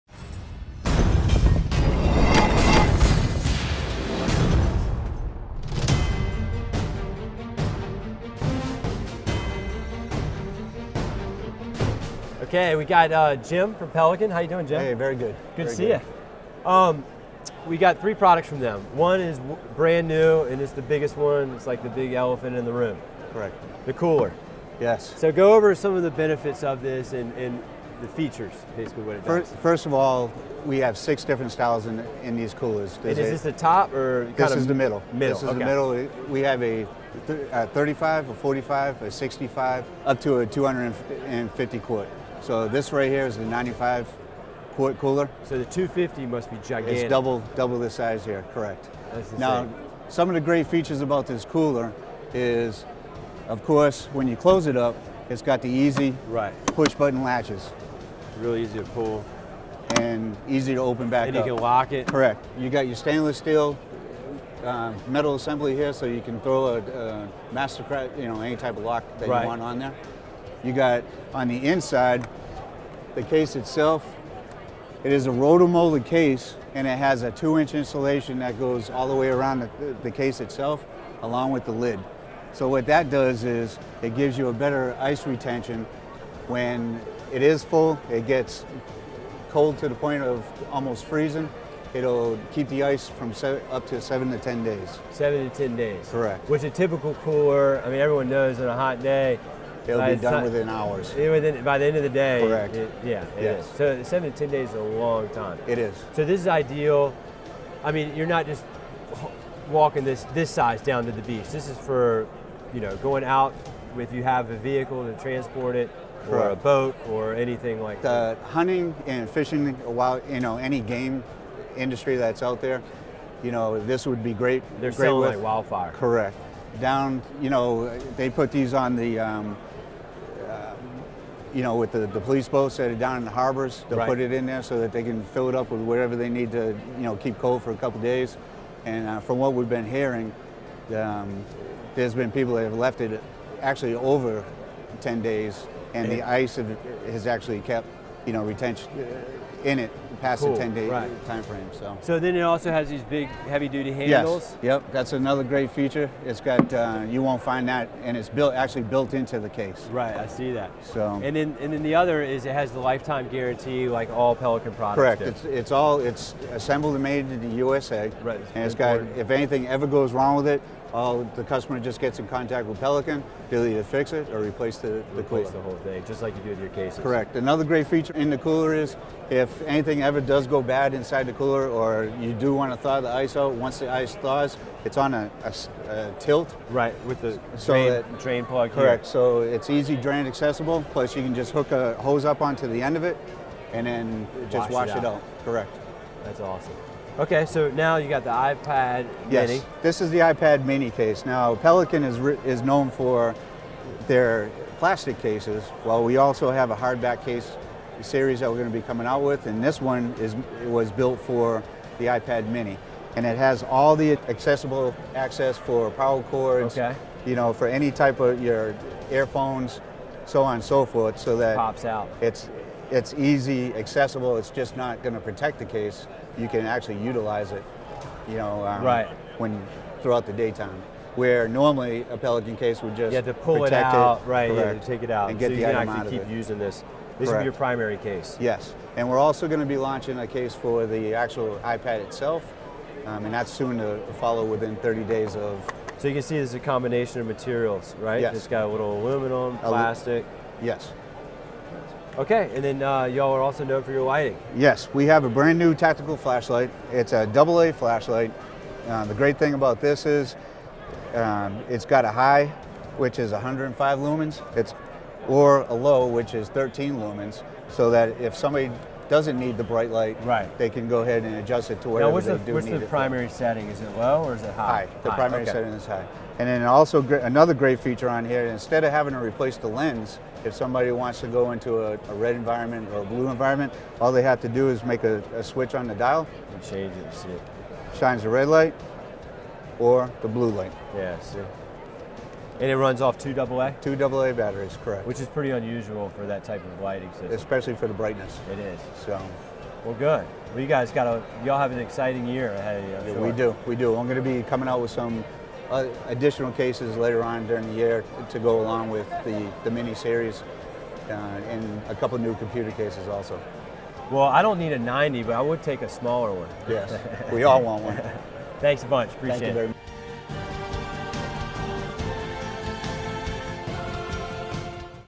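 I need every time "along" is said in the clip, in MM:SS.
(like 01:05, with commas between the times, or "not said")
01:21, 05:08.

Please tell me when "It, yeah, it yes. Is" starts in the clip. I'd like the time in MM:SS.
01:42.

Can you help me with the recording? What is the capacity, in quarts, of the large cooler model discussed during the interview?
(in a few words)
95 quart.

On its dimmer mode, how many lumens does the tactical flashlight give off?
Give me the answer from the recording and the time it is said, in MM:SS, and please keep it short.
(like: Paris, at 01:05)
13 lumens, at 04:26.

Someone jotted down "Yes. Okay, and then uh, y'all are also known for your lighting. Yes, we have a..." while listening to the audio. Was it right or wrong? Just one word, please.
right.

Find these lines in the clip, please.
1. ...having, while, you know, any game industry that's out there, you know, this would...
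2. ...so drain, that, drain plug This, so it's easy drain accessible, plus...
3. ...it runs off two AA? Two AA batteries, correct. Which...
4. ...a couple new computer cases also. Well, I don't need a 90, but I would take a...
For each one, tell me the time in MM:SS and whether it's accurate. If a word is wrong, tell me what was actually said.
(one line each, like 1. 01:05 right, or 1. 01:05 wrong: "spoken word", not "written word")
1. 01:59 wrong: "fishing", not "having"
2. 03:07 wrong: "Correct", not "This"
3. 04:52 right
4. 05:11 right.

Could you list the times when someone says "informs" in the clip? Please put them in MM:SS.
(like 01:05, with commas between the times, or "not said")
not said.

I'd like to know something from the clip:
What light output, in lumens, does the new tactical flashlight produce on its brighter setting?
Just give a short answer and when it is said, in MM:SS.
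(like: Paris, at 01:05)
105 lumens, at 04:23.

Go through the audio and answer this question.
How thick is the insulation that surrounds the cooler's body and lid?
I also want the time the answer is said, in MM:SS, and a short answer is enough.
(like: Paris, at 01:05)
two inch, at 01:17.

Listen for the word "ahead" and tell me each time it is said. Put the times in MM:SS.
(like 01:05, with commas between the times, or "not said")
04:31, 05:02.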